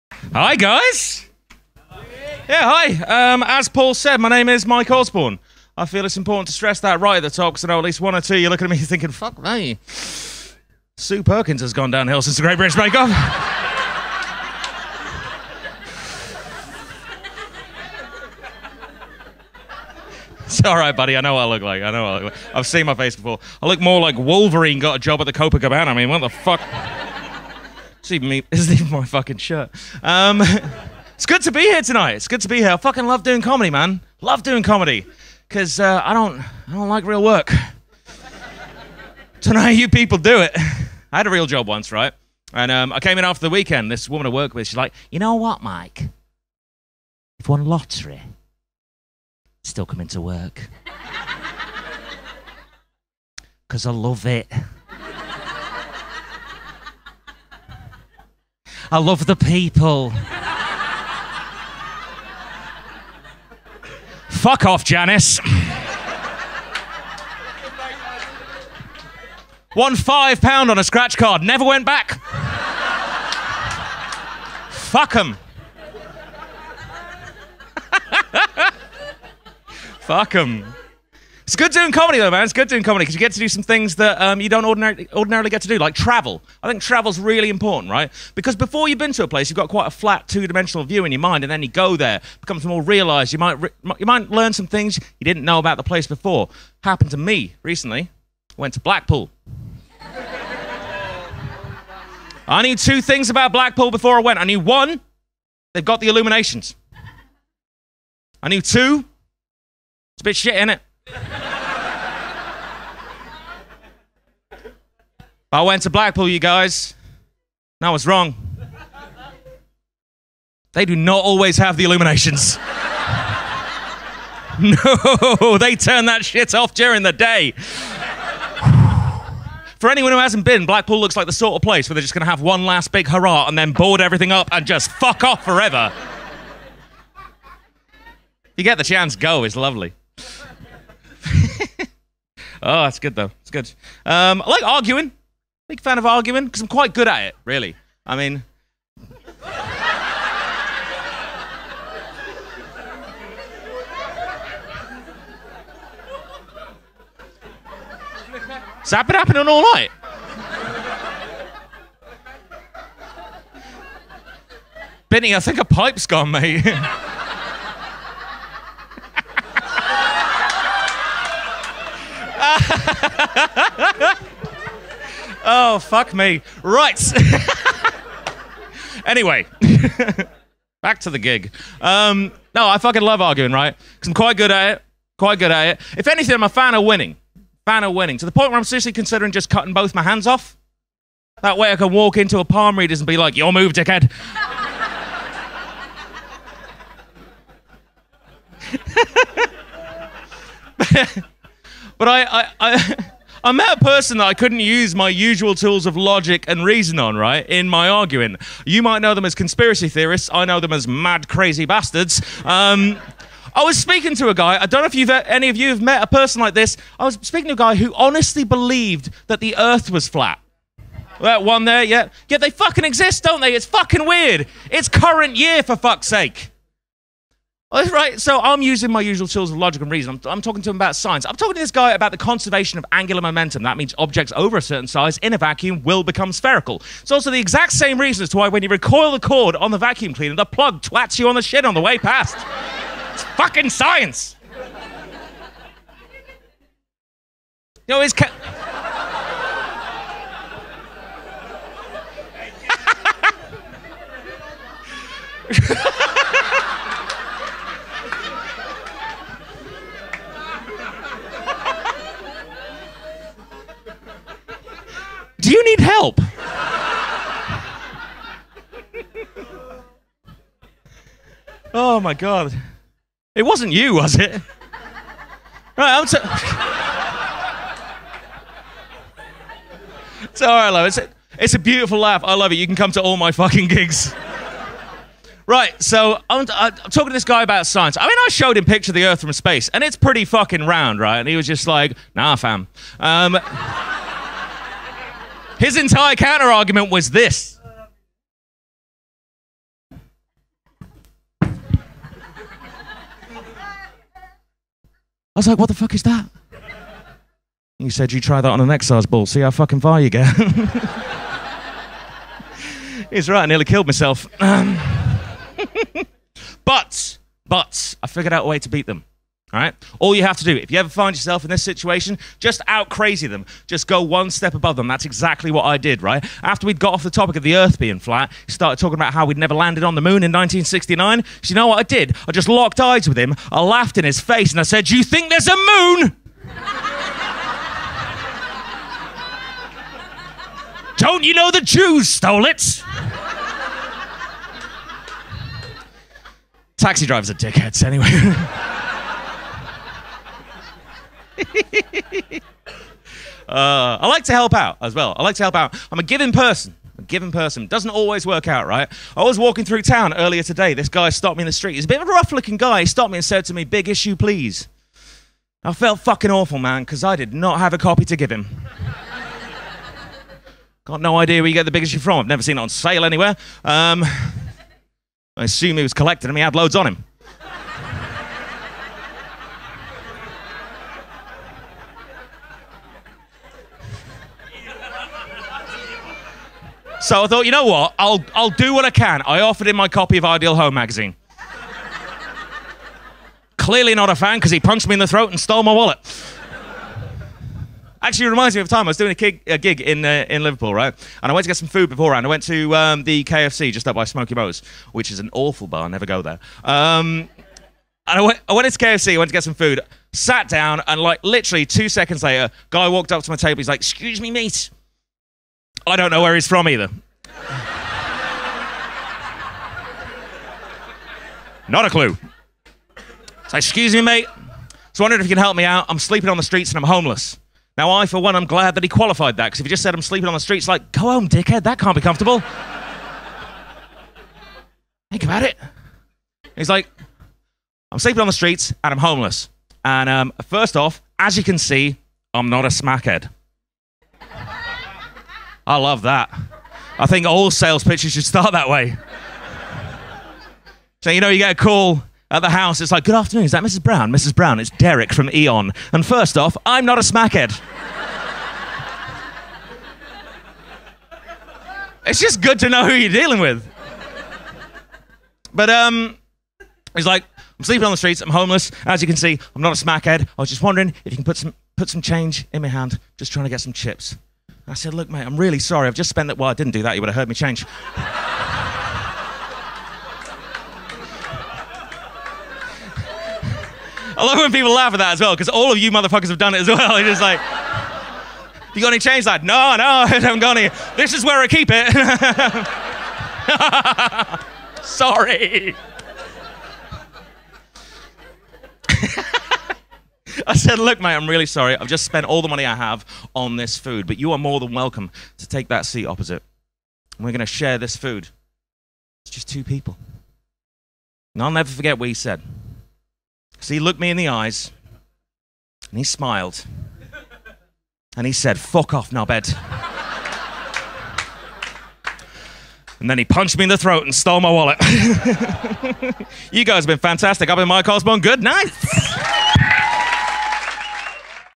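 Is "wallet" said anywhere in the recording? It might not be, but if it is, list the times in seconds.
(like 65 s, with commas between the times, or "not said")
395 s, 524 s.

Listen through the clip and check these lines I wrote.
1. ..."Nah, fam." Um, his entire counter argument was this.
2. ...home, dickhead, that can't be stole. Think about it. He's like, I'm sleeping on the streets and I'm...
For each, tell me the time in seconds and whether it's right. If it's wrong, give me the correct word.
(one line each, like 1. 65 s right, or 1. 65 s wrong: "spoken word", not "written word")
1. 292 s right
2. 431 s wrong: "comfortable", not "stole".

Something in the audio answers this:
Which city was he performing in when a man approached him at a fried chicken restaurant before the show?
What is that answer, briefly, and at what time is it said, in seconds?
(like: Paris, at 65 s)
Liverpool, at 400 s.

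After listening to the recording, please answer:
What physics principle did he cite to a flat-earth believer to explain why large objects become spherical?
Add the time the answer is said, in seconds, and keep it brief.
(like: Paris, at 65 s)
conservation of angular momentum, at 232 s.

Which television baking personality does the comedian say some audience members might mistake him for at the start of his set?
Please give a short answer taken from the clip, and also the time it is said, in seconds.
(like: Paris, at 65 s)
Sue Perkins, at 10 s.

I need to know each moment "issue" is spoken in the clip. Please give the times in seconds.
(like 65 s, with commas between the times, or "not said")
363 s, 371 s.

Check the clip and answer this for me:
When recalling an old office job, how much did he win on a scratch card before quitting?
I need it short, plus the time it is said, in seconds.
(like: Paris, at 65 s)
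5 pounds, at 69 s.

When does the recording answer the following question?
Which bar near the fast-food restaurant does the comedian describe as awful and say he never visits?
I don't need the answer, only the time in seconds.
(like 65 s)
404 s.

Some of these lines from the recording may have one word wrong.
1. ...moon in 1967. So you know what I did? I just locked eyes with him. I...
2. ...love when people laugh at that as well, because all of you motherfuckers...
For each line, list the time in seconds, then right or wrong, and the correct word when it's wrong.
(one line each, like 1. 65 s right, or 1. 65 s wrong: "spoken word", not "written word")
1. 330 s wrong: "1969", not "1967"
2. 484 s right.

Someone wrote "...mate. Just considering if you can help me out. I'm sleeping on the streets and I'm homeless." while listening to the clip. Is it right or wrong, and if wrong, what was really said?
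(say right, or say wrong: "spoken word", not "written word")
wrong: "wondering", not "considering".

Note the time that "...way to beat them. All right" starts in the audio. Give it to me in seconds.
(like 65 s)
318 s.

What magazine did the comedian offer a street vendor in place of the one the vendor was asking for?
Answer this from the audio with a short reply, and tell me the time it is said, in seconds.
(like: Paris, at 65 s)
Ideal Home, at 390 s.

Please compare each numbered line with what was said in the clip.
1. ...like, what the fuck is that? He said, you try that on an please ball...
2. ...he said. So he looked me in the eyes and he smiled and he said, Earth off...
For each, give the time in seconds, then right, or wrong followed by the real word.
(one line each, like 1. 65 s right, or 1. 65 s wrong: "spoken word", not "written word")
1. 305 s wrong: "exercise", not "please"
2. 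512 s wrong: "Fuck", not "Earth".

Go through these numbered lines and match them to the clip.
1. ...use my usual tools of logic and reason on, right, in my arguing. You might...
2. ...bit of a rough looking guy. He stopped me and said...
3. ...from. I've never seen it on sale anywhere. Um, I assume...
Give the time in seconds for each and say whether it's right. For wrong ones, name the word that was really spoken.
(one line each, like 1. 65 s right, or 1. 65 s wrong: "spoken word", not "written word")
1. 204 s right
2. 361 s right
3. 371 s right.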